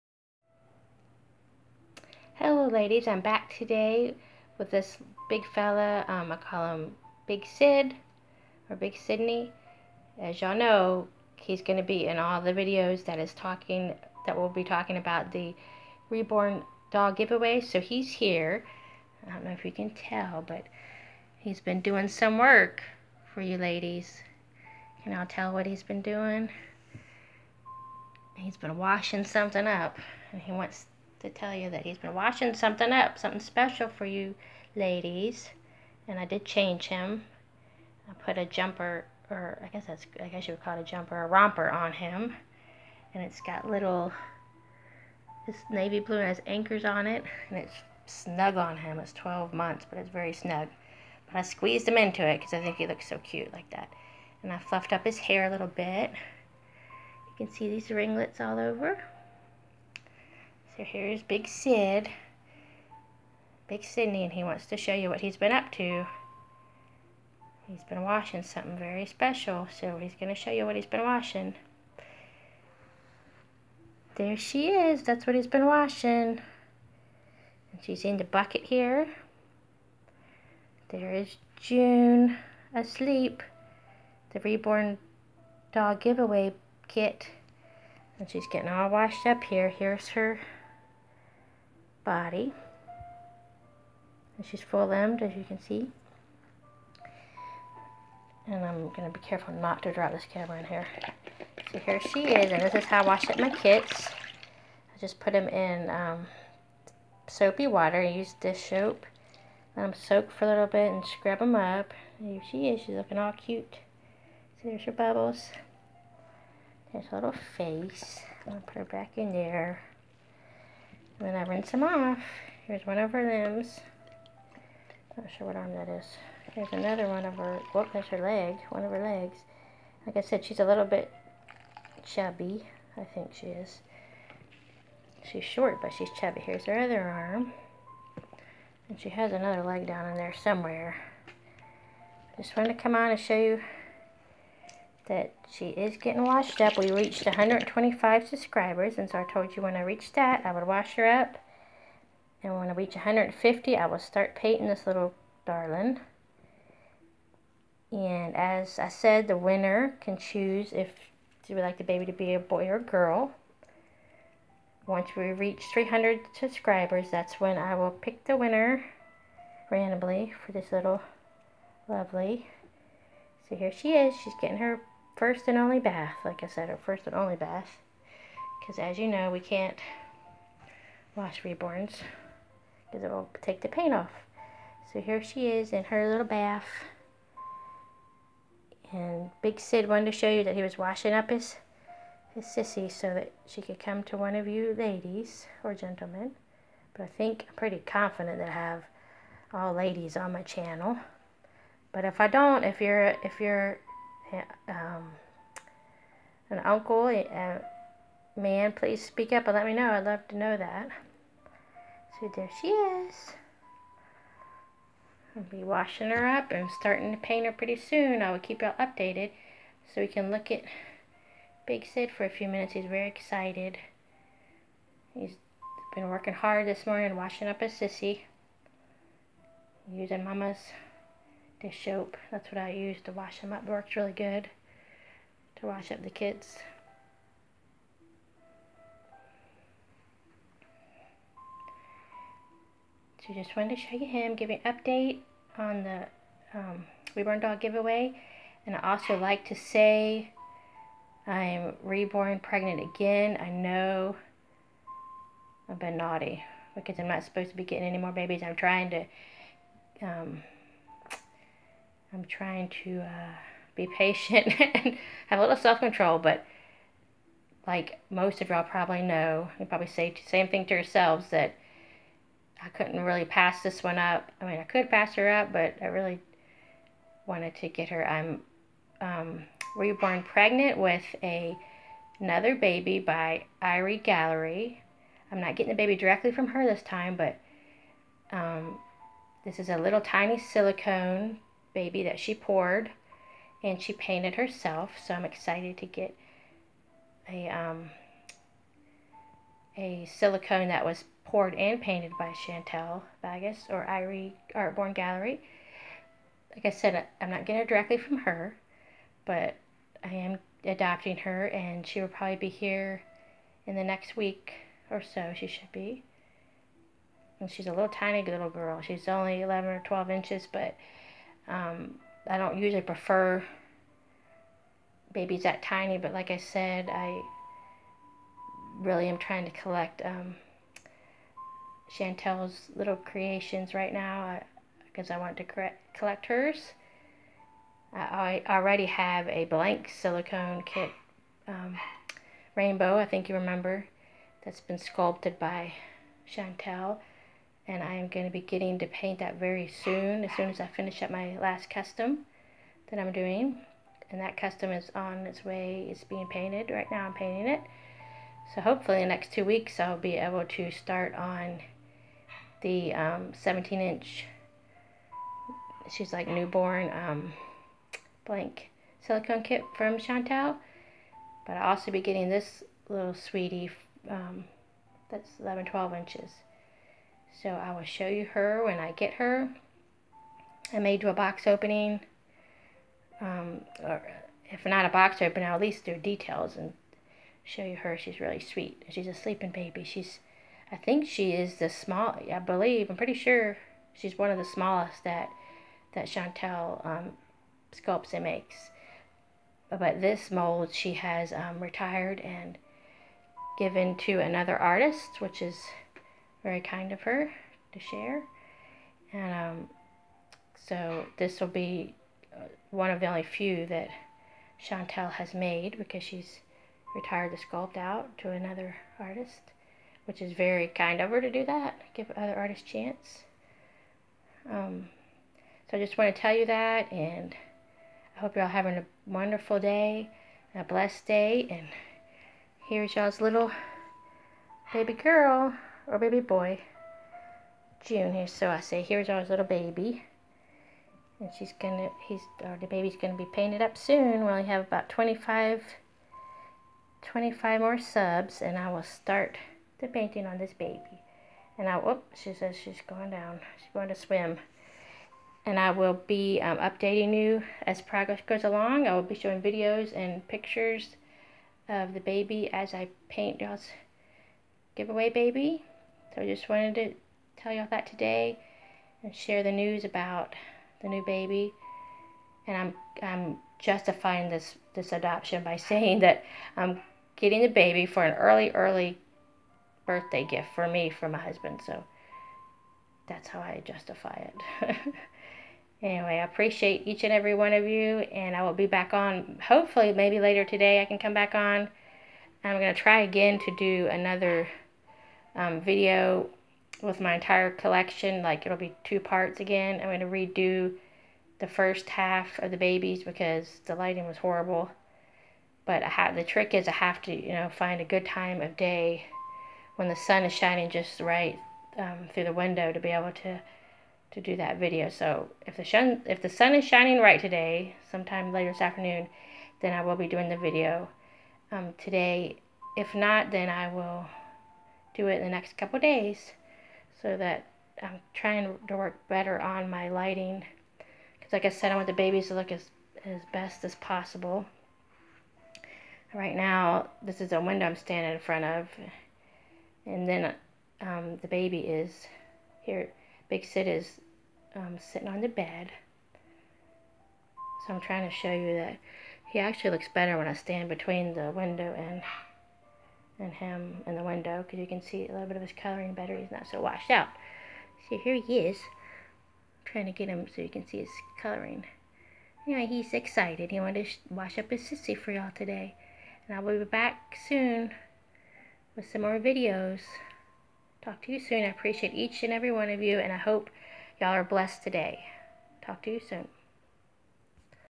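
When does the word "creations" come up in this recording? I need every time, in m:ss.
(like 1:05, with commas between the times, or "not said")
5:32.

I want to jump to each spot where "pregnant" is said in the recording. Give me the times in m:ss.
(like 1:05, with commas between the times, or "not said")
4:12, 4:40.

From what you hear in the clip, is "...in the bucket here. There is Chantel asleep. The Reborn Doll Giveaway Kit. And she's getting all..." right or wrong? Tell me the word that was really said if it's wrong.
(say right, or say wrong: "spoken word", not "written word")
wrong: "June", not "Chantel".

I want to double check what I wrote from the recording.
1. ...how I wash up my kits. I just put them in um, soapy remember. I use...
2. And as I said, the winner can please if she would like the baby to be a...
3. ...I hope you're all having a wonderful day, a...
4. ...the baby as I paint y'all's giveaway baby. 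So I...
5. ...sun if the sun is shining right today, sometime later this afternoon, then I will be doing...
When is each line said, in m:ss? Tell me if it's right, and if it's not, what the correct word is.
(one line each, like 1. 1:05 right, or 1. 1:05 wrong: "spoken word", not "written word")
1. 1:42 wrong: "water", not "remember"
2. 2:37 wrong: "choose", not "please"
3. 7:08 right
4. 7:41 right
5. 8:35 right.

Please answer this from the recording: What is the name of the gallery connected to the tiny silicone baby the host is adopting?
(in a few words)
Irie Gallery.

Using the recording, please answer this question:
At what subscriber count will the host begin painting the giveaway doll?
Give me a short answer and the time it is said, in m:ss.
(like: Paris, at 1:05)
150, at 2:32.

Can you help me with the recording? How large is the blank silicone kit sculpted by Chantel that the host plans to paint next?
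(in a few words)
17 inch.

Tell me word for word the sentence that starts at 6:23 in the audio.
Um, or if not a box opening, I'll at least do details and show you her.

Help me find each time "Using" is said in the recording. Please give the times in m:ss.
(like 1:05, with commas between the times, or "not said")
3:49.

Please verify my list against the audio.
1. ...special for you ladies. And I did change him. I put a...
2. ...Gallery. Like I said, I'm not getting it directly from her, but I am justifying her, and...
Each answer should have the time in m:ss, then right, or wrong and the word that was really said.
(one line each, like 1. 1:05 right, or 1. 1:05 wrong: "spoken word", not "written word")
1. 0:33 right
2. 5:04 wrong: "adopting", not "justifying".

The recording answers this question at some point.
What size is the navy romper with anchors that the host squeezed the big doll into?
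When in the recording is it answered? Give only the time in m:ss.
0:49.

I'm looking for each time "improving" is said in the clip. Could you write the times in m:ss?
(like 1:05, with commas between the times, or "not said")
not said.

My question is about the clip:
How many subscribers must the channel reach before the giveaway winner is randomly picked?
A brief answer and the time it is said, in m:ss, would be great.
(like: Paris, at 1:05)
300, at 2:45.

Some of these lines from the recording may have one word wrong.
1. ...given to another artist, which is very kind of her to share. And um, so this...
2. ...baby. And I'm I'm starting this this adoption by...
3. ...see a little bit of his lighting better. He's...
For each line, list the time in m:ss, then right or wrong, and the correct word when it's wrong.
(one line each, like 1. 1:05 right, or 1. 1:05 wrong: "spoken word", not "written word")
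1. 6:43 right
2. 7:51 wrong: "justifying", not "starting"
3. 9:14 wrong: "coloring", not "lighting".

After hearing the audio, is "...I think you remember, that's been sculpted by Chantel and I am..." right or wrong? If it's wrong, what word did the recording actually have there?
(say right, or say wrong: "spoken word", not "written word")
right.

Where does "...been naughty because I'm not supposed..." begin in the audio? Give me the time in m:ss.
4:15.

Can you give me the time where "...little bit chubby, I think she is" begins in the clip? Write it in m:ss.
2:10.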